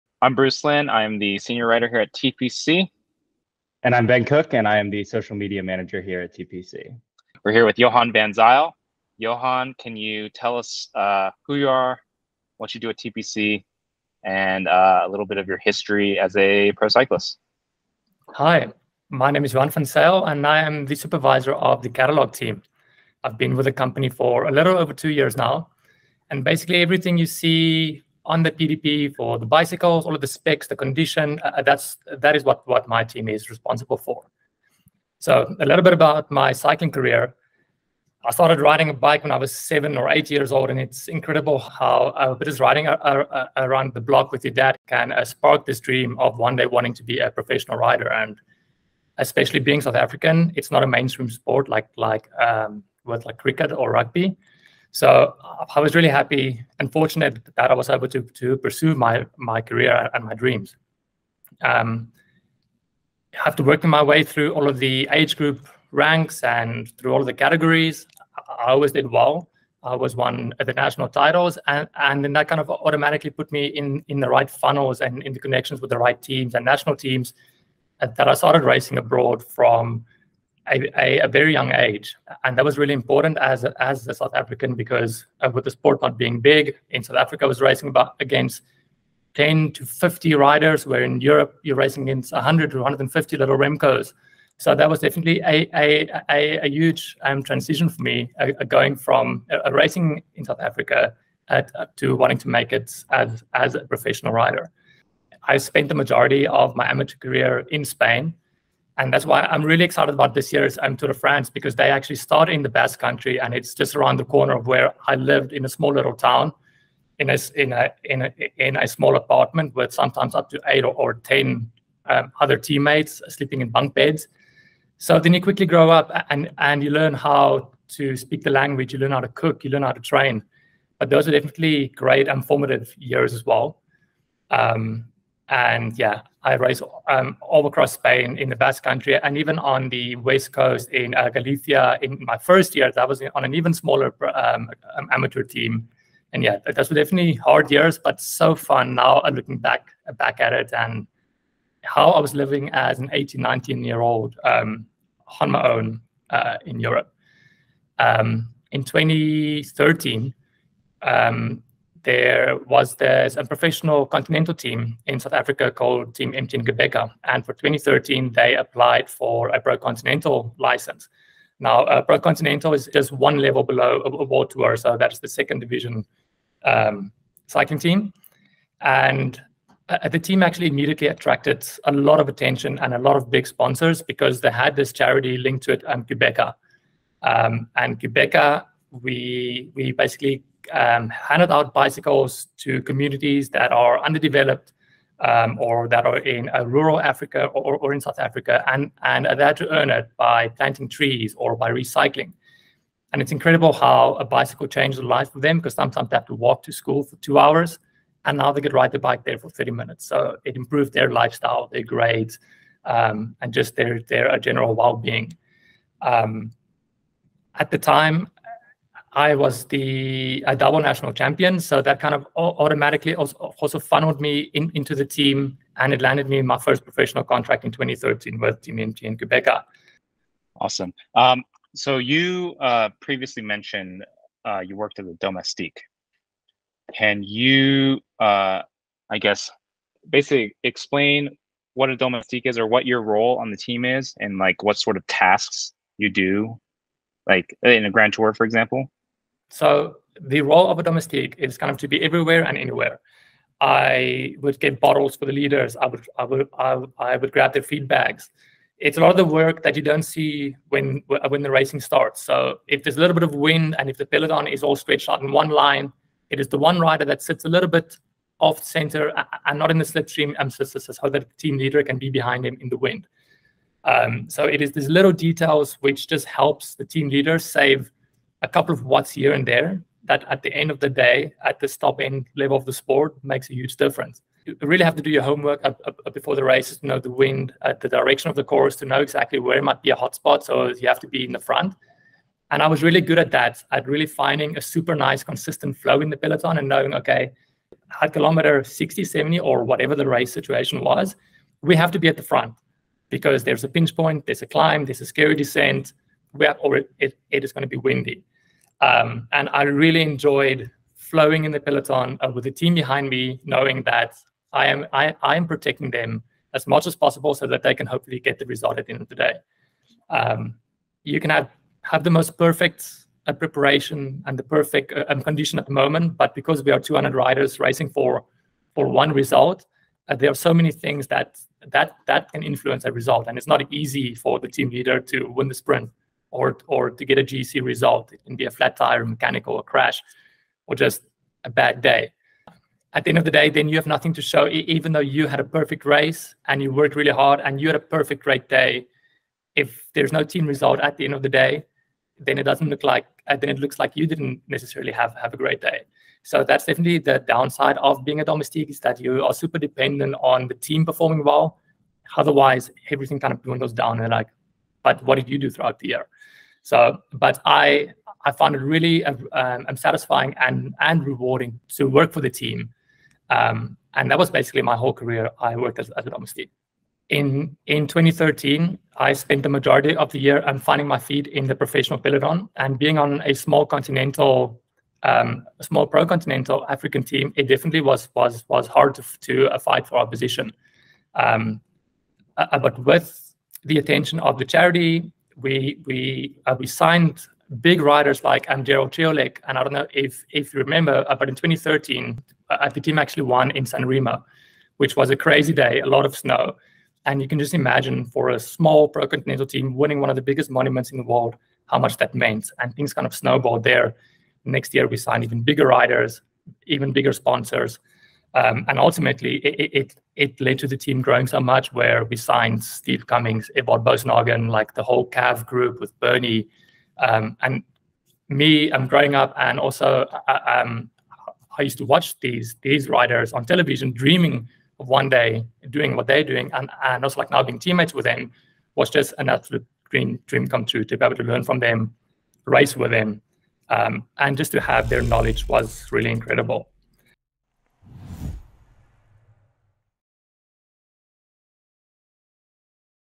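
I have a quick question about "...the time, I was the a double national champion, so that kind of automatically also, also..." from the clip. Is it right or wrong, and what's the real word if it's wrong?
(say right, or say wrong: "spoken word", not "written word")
right.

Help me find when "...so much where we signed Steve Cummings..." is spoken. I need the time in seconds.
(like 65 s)
421 s.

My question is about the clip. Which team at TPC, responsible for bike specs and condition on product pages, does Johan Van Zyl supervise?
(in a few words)
catalog team.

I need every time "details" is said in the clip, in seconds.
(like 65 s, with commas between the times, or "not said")
275 s.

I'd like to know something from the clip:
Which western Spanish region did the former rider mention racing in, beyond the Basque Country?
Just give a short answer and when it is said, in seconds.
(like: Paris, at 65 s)
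Galicia, at 141 s.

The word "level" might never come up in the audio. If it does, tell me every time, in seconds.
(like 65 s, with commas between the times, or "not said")
173 s, 282 s.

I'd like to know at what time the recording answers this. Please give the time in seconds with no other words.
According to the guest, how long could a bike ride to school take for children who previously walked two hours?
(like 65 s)
209 s.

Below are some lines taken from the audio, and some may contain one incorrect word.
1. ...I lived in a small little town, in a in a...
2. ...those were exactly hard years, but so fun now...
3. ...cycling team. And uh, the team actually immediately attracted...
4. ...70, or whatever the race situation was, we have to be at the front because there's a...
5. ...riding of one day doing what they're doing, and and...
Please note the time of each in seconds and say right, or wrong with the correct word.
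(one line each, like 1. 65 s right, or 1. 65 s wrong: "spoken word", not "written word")
1. 115 s right
2. 146 s wrong: "definitely", not "exactly"
3. 177 s right
4. 299 s right
5. 433 s wrong: "dreaming", not "riding".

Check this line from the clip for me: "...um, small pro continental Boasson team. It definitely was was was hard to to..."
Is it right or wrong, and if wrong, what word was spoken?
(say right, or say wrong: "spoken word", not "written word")
wrong: "African", not "Boasson".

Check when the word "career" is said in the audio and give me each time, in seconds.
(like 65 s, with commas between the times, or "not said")
36 s, 59 s, 107 s, 374 s.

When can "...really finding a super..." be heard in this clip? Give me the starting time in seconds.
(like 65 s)
293 s.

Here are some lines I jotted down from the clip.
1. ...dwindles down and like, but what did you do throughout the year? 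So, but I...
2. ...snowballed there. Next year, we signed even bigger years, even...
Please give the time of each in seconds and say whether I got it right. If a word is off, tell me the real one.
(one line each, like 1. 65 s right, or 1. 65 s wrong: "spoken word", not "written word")
1. 363 s right
2. 413 s wrong: "riders", not "years".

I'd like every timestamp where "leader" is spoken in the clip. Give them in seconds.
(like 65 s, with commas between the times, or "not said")
255 s, 271 s, 277 s, 334 s.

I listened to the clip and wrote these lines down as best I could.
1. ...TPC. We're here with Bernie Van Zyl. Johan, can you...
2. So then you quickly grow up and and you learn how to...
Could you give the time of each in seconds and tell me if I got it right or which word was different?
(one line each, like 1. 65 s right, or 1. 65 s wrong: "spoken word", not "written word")
1. 6 s wrong: "Johan", not "Bernie"
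2. 124 s right.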